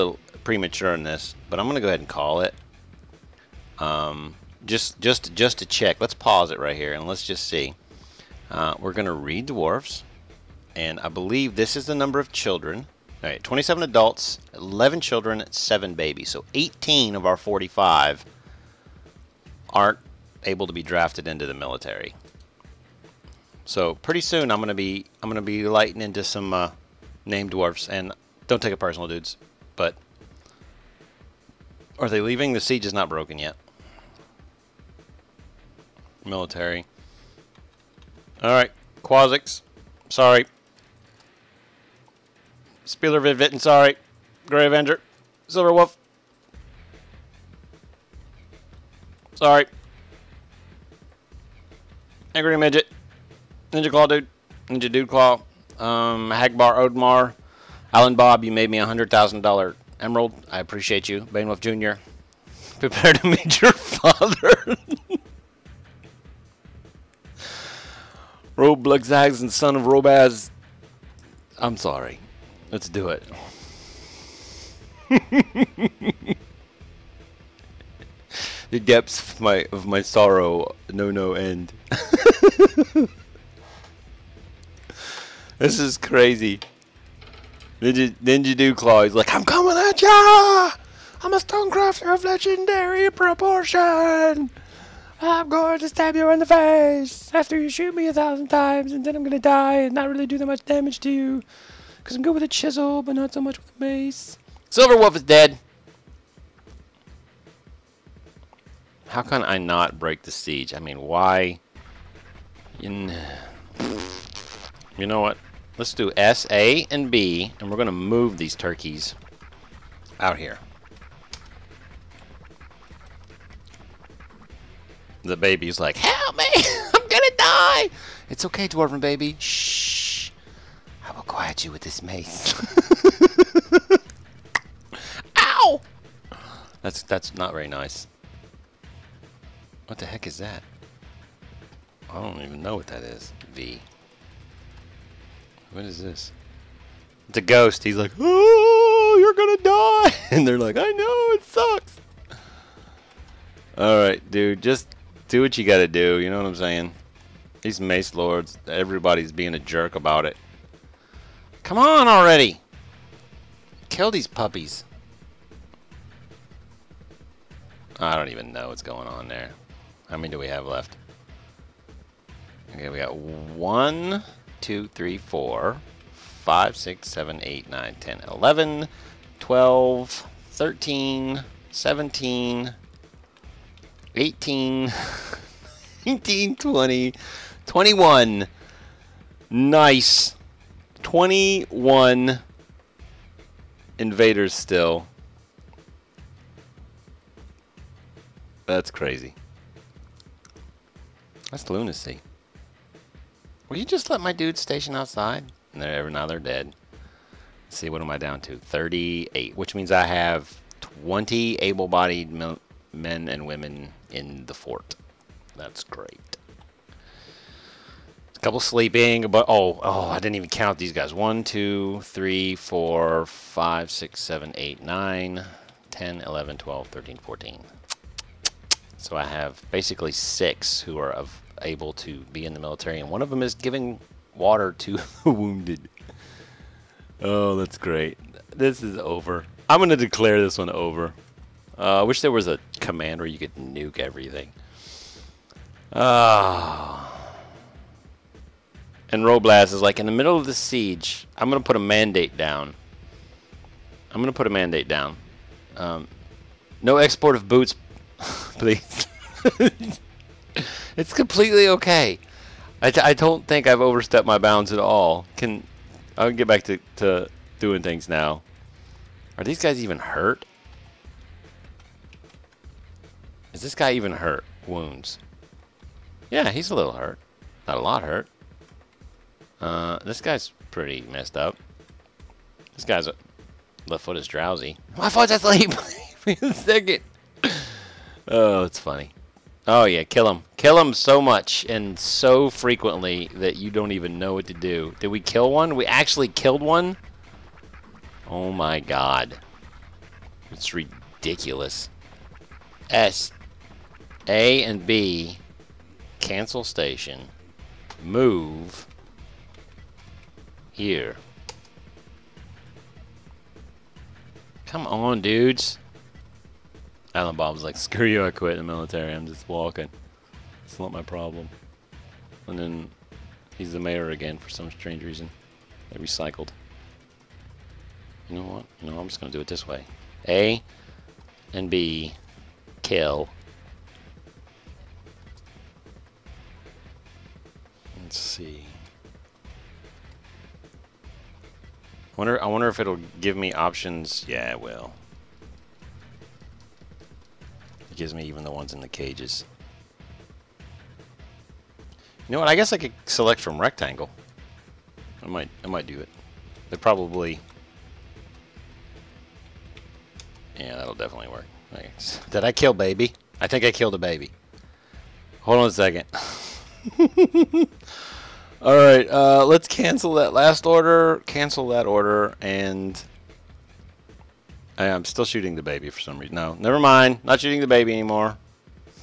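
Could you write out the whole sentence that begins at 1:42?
Because I'm good with a chisel, but not so much with a mace.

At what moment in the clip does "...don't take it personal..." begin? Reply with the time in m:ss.
0:28.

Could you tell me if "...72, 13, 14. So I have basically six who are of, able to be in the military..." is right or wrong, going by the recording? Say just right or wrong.
wrong.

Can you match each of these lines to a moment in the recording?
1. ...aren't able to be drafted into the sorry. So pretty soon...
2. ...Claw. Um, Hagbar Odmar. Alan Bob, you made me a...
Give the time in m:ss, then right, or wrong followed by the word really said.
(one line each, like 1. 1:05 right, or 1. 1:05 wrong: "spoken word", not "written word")
1. 0:19 wrong: "military", not "sorry"
2. 0:55 right.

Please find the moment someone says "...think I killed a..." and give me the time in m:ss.
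6:03.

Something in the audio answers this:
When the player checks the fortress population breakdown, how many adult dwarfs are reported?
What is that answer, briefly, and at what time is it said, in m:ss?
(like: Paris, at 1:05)
27, at 0:13.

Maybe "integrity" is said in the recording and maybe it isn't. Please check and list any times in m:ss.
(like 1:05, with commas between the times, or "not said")
not said.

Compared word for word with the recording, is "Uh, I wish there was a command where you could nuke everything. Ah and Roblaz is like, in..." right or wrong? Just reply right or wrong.
right.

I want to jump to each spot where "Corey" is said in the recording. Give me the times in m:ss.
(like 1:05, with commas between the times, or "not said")
not said.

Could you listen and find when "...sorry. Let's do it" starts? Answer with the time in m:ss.
1:11.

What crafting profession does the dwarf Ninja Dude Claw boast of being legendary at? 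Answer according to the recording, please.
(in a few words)
Stonecrafter.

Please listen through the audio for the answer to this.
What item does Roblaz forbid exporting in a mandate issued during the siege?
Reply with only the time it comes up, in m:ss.
4:17.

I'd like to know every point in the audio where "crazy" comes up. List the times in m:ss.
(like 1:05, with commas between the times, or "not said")
1:25, 3:18.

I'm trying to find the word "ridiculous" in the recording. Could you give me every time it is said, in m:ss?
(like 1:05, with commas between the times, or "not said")
5:00.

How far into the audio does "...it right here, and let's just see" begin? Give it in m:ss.
0:06.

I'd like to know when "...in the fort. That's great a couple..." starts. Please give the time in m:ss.
3:34.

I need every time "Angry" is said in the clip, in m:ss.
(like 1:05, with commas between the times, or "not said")
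0:52.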